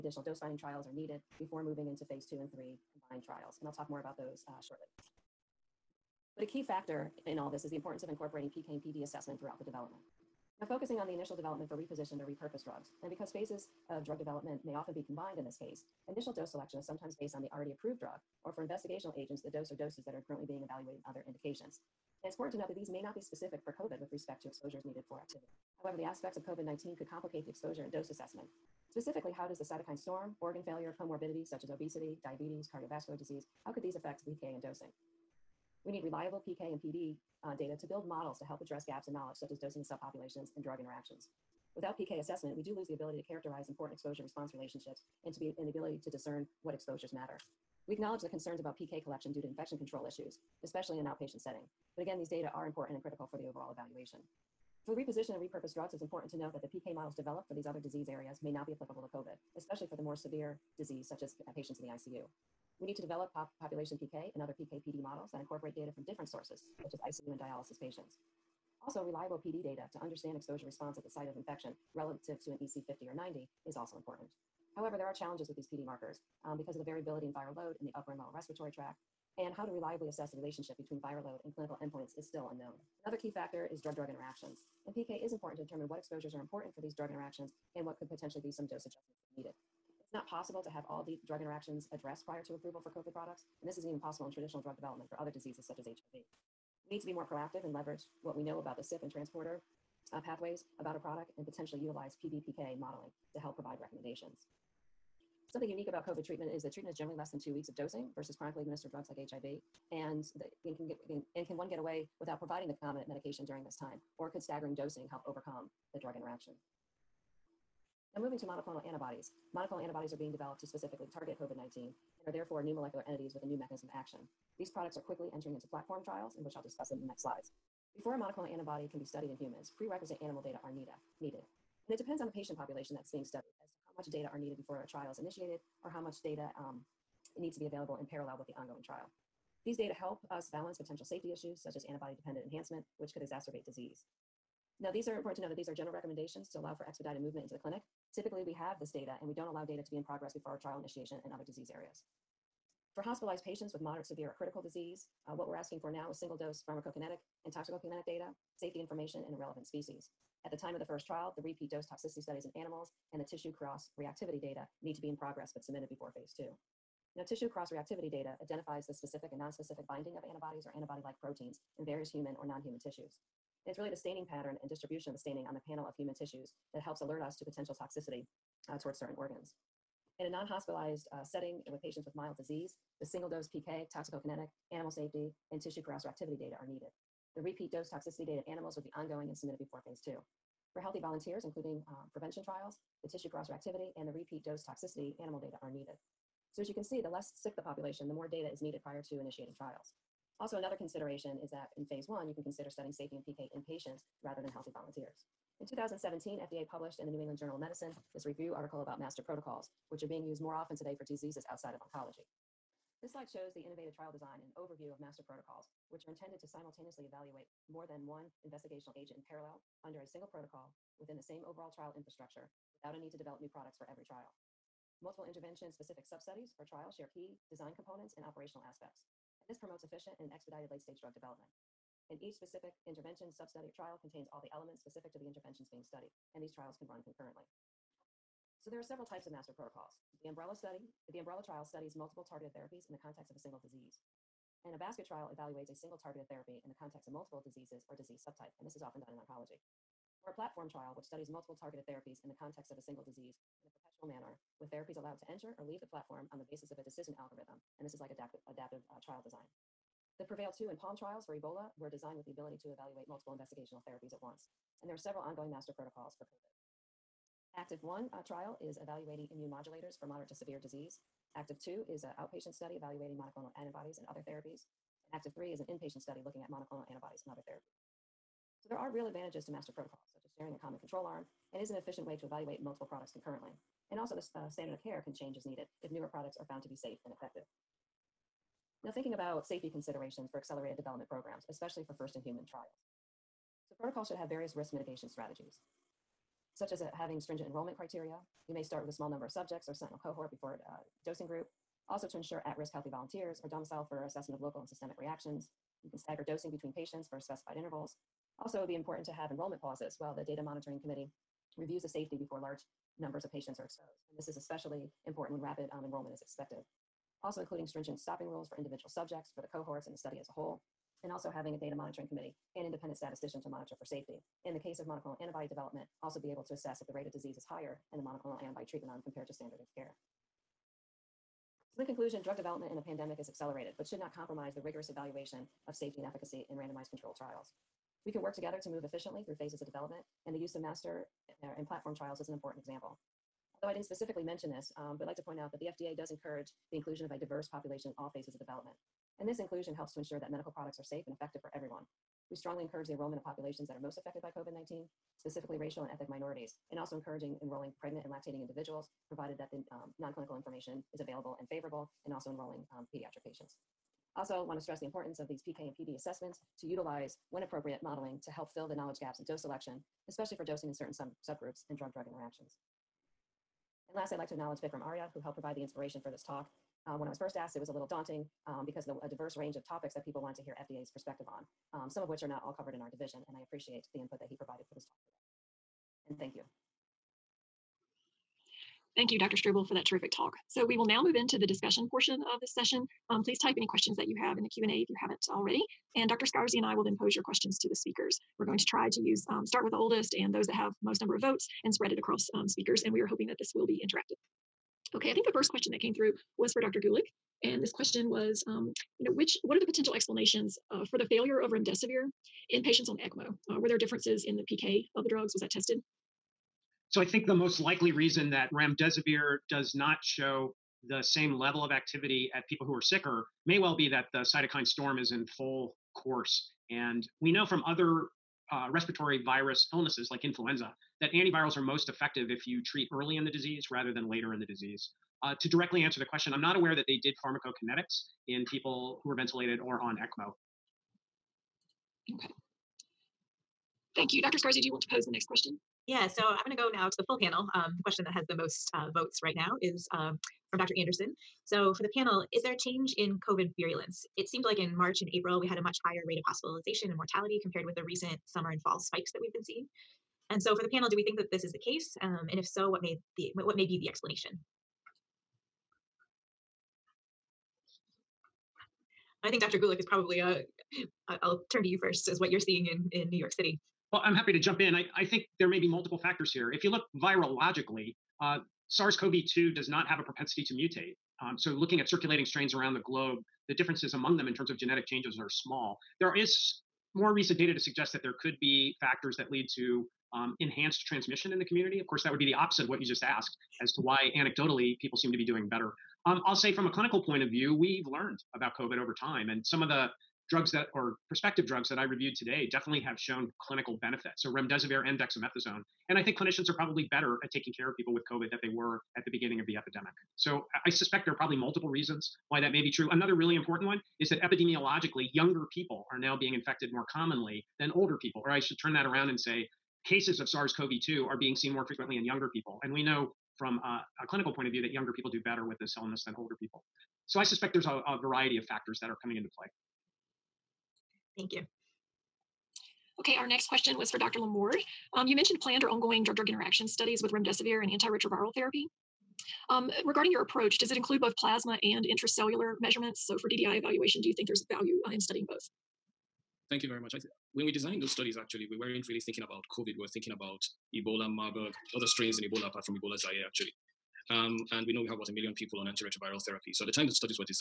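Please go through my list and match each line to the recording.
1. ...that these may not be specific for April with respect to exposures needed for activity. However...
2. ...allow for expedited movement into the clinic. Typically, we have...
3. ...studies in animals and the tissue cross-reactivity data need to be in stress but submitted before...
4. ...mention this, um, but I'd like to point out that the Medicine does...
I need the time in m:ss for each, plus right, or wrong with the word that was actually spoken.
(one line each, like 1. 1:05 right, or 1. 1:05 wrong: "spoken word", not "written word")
1. 0:22 wrong: "COVID", not "April"
2. 2:26 right
3. 2:42 wrong: "progress", not "stress"
4. 5:44 wrong: "FDA", not "Medicine".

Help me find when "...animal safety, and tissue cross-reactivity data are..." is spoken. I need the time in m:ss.
3:04.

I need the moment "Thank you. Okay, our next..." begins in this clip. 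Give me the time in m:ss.
8:51.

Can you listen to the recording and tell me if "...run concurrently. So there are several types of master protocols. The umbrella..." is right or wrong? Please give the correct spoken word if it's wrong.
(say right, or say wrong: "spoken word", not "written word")
right.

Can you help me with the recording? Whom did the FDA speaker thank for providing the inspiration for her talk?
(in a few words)
Vikram Arya.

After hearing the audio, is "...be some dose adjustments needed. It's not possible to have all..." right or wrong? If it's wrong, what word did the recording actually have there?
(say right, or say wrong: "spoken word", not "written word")
right.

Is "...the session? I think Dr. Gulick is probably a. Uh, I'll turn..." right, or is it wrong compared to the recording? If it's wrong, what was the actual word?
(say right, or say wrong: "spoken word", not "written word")
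wrong: "explanation", not "session".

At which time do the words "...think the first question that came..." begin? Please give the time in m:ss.
6:45.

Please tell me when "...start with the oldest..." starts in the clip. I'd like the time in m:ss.
6:39.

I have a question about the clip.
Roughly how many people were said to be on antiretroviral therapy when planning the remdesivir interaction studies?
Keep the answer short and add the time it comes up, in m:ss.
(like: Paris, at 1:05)
About 1 million, at 9:14.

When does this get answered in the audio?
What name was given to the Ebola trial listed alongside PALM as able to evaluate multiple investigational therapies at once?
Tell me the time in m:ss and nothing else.
4:20.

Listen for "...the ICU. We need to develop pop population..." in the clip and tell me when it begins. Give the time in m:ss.
1:01.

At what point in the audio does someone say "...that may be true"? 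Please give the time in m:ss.
8:32.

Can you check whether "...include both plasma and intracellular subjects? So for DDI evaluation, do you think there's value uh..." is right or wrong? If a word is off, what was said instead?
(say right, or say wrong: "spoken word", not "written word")
wrong: "measurements", not "subjects".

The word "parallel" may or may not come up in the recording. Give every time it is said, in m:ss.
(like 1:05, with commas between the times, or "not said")
2:18, 3:39.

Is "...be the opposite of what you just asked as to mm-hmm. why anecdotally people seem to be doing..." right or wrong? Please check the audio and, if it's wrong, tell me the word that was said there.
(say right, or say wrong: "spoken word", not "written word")
right.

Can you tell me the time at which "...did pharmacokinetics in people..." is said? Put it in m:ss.
7:17.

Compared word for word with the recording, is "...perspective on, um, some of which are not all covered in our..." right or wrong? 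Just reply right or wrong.
right.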